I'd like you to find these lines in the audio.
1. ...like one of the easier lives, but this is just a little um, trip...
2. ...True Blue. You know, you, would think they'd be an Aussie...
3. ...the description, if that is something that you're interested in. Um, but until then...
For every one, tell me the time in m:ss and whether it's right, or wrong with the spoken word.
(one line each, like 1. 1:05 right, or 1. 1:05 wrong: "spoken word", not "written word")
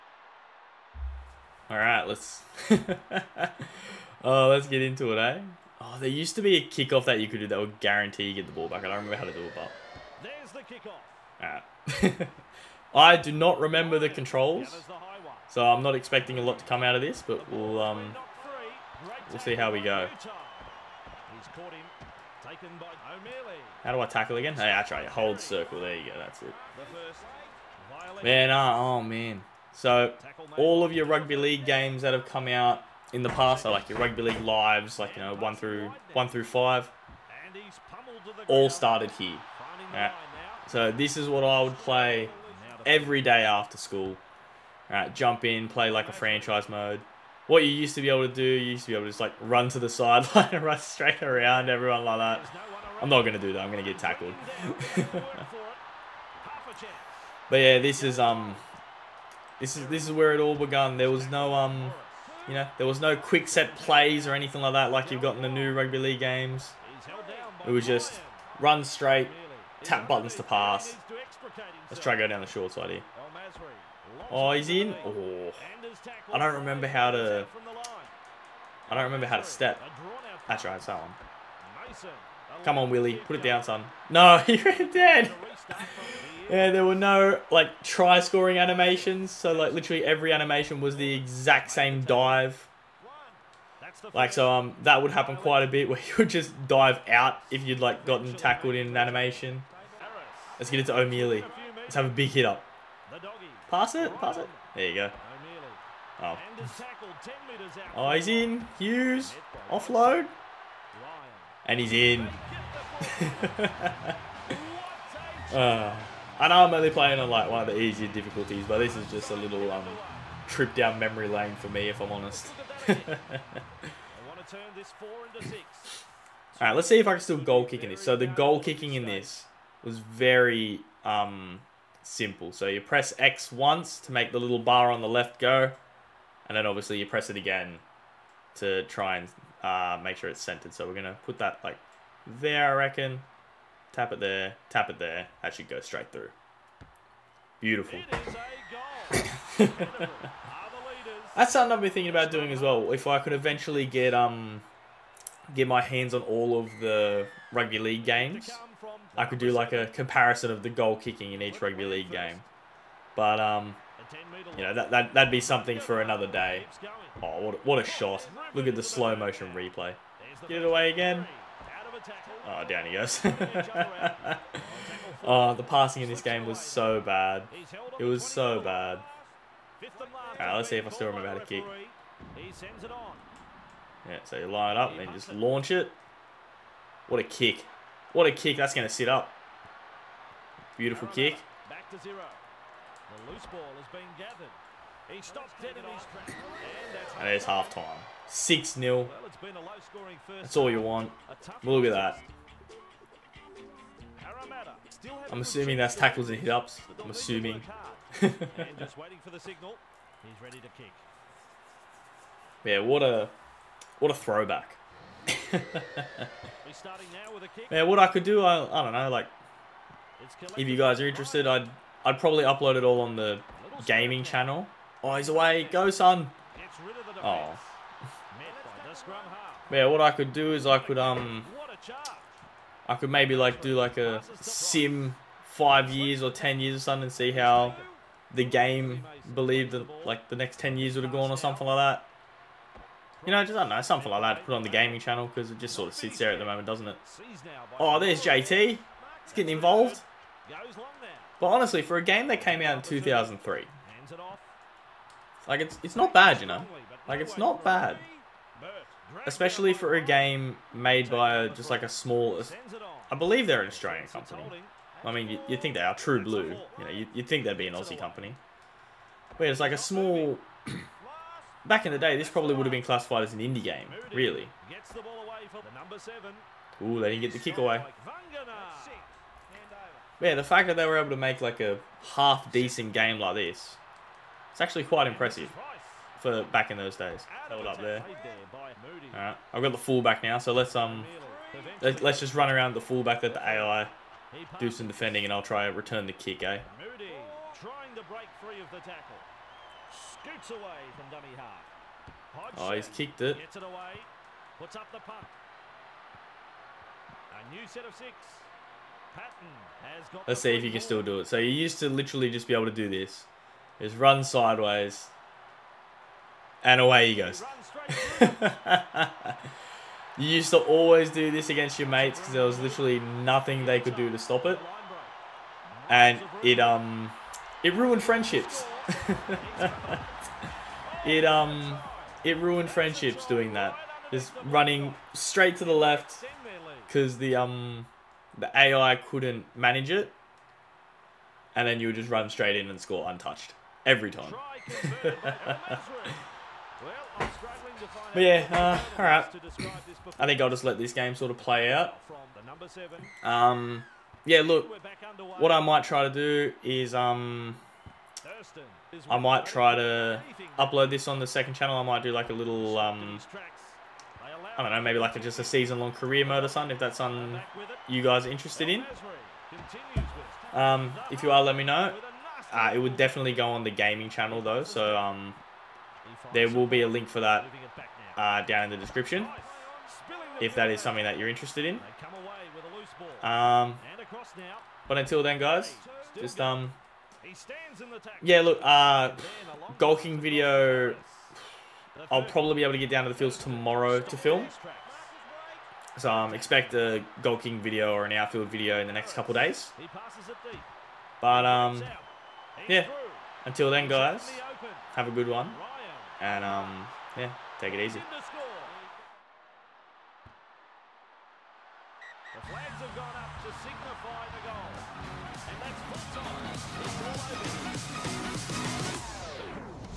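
1. 1:57 wrong: "difficulties", not "lives"
2. 4:25 right
3. 6:18 right.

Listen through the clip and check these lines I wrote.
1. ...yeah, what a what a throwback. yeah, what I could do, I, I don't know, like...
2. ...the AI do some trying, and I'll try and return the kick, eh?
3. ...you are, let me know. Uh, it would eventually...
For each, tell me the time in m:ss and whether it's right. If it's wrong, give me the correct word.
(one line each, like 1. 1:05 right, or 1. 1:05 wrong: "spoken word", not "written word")
1. 3:32 right
2. 4:53 wrong: "defending", not "trying"
3. 6:11 wrong: "definitely", not "eventually".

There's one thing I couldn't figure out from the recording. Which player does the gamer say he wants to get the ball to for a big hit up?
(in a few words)
O'Meley.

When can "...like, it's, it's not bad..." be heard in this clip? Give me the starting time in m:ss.
4:15.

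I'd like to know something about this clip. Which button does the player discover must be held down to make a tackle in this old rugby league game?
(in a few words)
Circle.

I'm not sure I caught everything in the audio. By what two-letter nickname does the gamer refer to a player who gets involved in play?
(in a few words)
JT.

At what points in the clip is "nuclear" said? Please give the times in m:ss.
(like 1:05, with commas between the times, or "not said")
not said.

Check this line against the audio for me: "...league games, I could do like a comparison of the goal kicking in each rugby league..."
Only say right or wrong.
right.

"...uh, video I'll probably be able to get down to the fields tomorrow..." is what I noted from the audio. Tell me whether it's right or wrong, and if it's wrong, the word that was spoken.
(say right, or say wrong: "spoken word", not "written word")
right.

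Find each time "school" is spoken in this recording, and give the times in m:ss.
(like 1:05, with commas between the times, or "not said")
0:43.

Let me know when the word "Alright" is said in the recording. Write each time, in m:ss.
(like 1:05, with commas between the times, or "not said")
2:06, 3:00.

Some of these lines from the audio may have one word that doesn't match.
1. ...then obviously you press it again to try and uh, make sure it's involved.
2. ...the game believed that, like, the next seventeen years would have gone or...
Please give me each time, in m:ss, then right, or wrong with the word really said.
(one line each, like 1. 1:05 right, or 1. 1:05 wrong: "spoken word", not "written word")
1. 2:16 wrong: "centered", not "involved"
2. 3:58 wrong: "ten", not "seventeen".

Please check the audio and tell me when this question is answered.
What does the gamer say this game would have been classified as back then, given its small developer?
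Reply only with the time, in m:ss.
4:33.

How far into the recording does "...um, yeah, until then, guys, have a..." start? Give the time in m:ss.
6:41.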